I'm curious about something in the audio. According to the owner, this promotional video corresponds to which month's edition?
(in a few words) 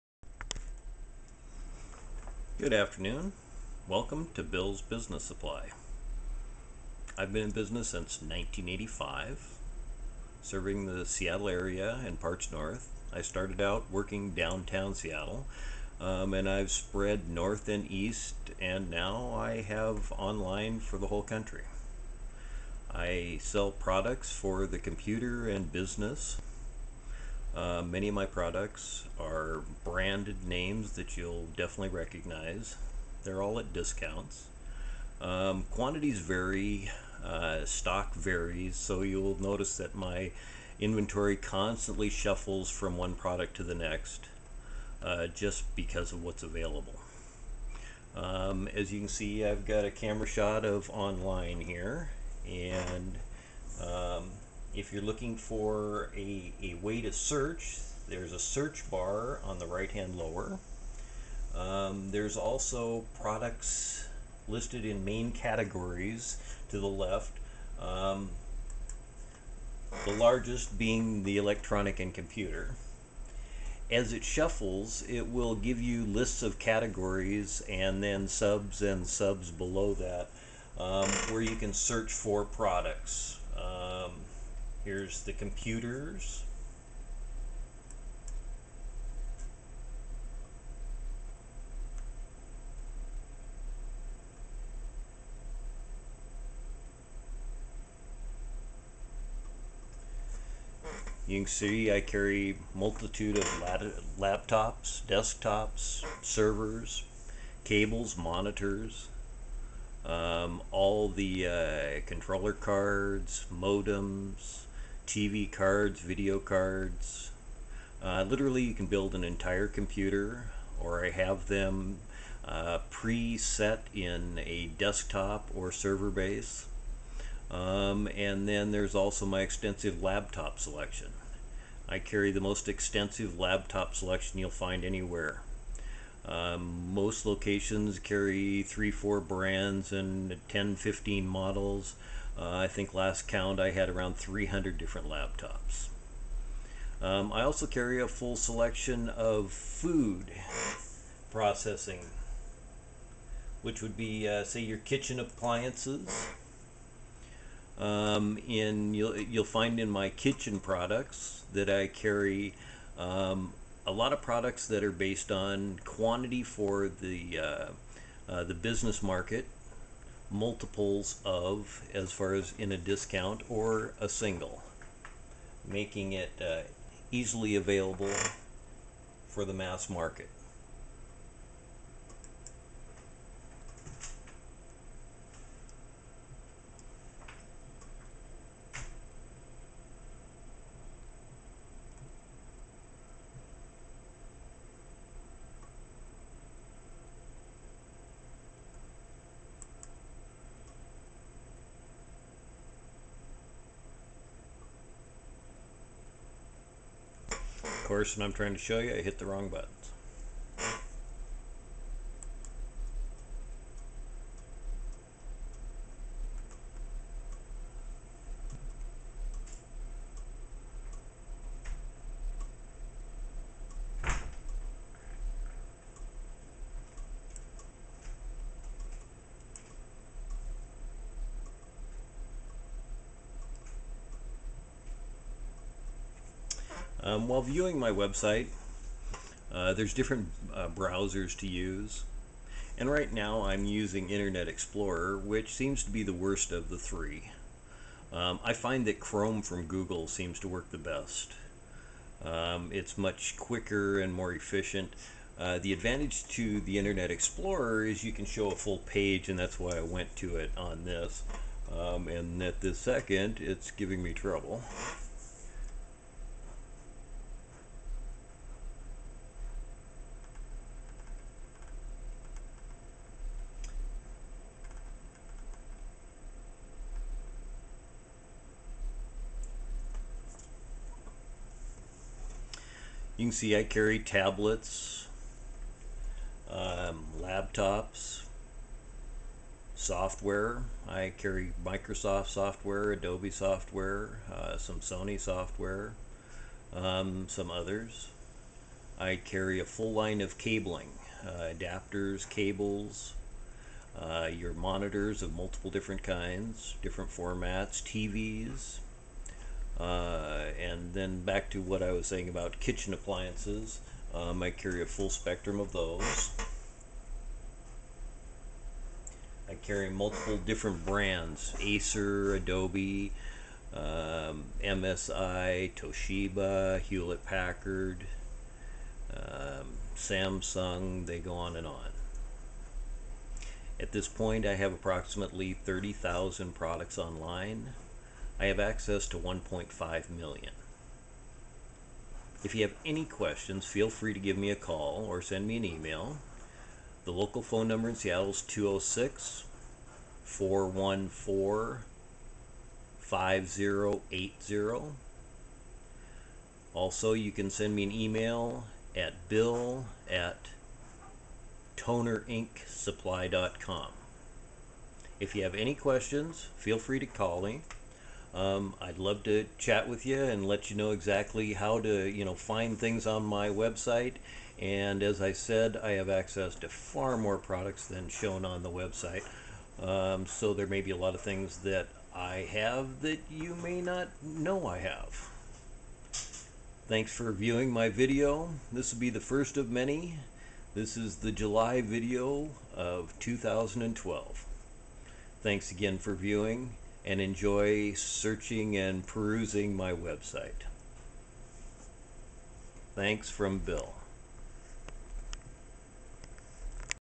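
July.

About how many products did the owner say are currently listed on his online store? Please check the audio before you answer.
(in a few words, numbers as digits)
30,000.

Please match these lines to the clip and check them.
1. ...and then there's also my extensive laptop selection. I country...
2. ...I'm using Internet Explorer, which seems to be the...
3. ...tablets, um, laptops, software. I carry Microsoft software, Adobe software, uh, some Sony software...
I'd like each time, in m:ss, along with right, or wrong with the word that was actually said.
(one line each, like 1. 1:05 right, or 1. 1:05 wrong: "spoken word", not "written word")
1. 2:08 wrong: "carry", not "country"
2. 4:03 right
3. 4:43 right.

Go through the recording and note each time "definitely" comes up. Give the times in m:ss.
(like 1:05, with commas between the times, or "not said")
0:31.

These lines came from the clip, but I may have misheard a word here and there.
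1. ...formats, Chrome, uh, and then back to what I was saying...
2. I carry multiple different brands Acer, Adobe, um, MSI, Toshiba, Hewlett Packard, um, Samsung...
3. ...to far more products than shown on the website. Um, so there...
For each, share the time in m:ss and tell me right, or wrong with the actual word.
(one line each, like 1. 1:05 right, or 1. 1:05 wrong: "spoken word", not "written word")
1. 5:07 wrong: "TVs", not "Chrome"
2. 5:19 right
3. 6:16 right.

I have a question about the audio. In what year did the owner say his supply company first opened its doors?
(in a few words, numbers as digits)
1985.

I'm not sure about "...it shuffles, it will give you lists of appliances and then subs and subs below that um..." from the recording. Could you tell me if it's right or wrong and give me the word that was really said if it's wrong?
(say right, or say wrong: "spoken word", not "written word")
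wrong: "categories", not "appliances".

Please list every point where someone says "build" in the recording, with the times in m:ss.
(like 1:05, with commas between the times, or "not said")
1:58.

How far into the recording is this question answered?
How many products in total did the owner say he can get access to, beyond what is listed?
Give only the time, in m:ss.
5:39.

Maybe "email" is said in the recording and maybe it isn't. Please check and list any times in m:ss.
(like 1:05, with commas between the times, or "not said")
5:45, 5:57.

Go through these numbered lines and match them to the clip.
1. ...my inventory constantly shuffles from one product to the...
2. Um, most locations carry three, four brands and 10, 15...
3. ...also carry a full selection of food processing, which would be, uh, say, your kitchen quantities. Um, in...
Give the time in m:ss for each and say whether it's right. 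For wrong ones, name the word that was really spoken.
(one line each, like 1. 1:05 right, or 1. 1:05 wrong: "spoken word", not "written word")
1. 0:39 right
2. 2:16 right
3. 2:27 wrong: "appliances", not "quantities".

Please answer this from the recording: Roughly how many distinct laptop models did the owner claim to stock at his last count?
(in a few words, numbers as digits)
300.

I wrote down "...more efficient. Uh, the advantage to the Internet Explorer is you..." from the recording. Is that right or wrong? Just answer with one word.
right.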